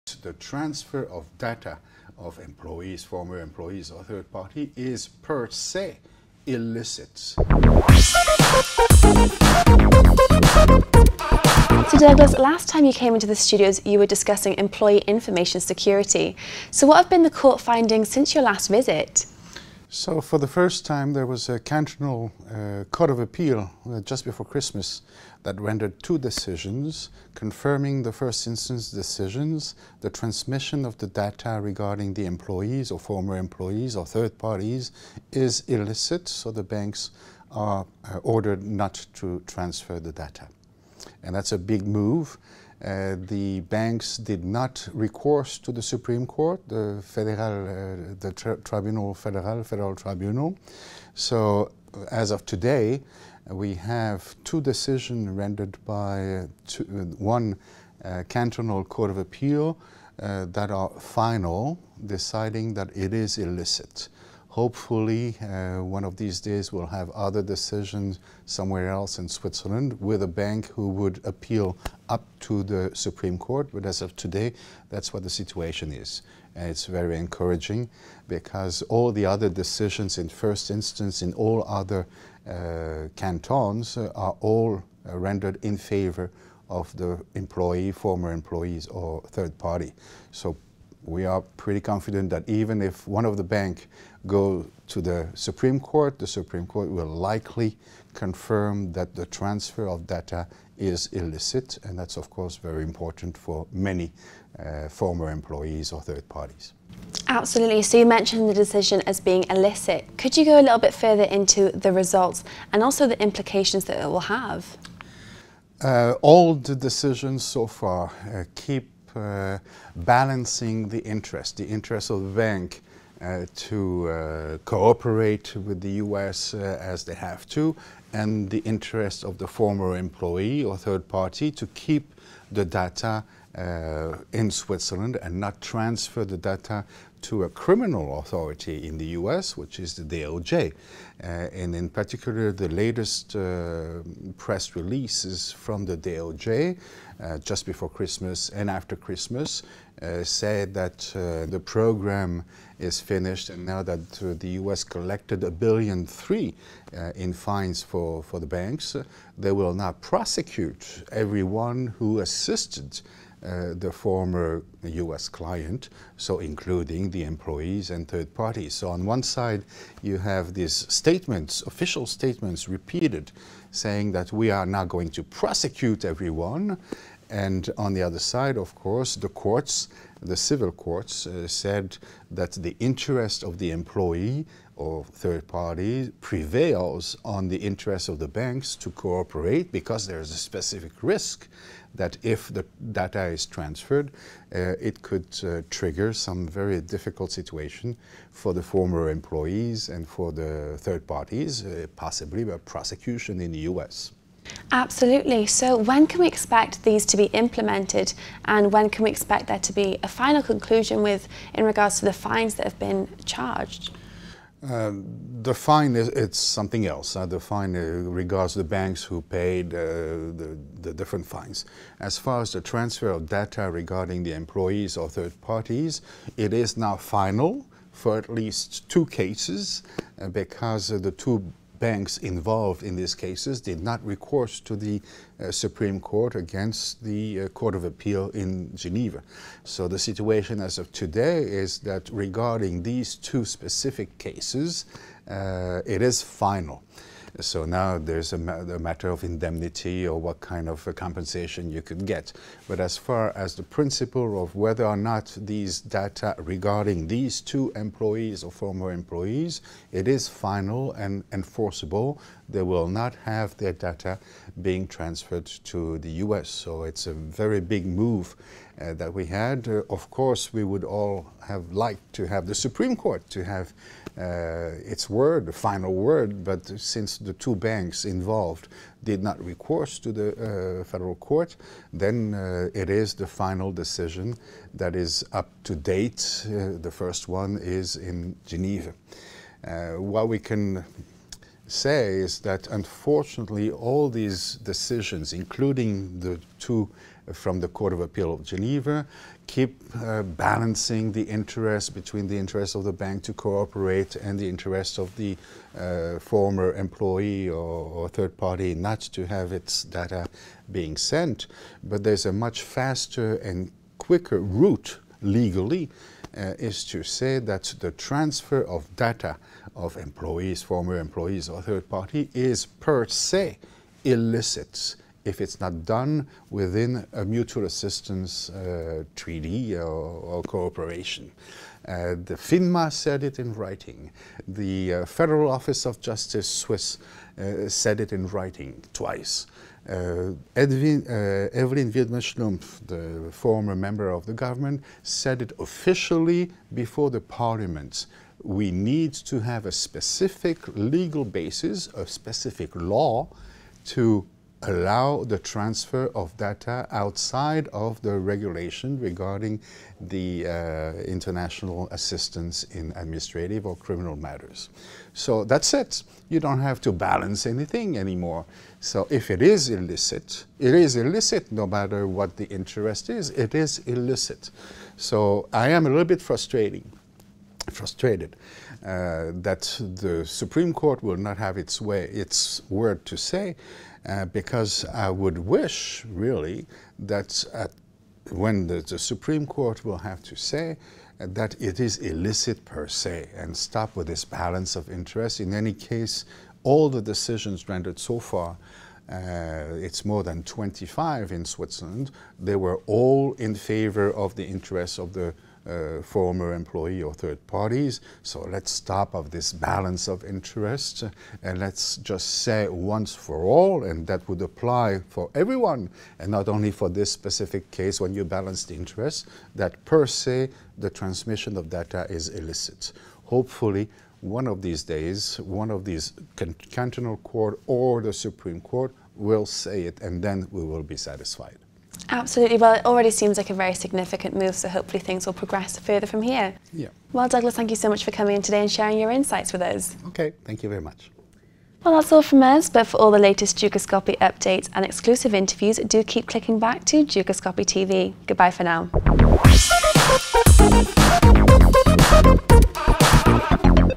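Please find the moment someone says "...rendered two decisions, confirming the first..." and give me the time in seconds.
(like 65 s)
25 s.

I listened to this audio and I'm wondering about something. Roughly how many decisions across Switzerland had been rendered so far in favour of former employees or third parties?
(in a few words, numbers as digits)
more than 25.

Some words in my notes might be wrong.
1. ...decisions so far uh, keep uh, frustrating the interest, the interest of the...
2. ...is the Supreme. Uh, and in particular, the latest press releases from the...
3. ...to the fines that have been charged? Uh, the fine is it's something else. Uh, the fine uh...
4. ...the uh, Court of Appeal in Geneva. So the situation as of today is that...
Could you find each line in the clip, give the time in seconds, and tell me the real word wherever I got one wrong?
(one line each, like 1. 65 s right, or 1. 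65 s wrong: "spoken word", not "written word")
1. 116 s wrong: "balancing", not "frustrating"
2. 139 s wrong: "DOJ", not "Supreme"
3. 211 s right
4. 237 s right.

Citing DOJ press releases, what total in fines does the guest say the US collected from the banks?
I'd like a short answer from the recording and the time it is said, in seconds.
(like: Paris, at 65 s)
a billion three, at 155 s.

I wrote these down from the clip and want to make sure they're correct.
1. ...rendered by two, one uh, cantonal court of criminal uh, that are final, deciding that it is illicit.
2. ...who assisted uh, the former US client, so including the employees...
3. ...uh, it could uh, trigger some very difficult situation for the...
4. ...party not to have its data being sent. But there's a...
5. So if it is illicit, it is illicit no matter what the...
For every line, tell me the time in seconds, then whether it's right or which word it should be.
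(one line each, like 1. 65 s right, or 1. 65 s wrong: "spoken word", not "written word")
1. 55 s wrong: "appeal", not "criminal"
2. 161 s right
3. 194 s right
4. 308 s right
5. 368 s right.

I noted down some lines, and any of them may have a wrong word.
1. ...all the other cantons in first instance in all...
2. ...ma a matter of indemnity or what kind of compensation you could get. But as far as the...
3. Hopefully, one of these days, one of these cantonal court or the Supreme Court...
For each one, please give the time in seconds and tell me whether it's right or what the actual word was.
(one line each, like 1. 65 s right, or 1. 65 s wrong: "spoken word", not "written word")
1. 78 s wrong: "decisions", not "cantons"
2. 248 s right
3. 423 s right.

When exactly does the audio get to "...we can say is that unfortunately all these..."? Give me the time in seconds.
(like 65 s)
290 s.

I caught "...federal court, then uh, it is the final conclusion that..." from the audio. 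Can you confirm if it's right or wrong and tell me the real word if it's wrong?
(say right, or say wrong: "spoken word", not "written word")
wrong: "decision", not "conclusion".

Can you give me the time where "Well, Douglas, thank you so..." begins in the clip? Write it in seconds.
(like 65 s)
437 s.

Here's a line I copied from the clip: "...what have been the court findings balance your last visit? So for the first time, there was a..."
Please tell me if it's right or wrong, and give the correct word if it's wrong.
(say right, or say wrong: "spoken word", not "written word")
wrong: "since", not "balance".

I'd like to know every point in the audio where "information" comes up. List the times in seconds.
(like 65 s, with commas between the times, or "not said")
14 s.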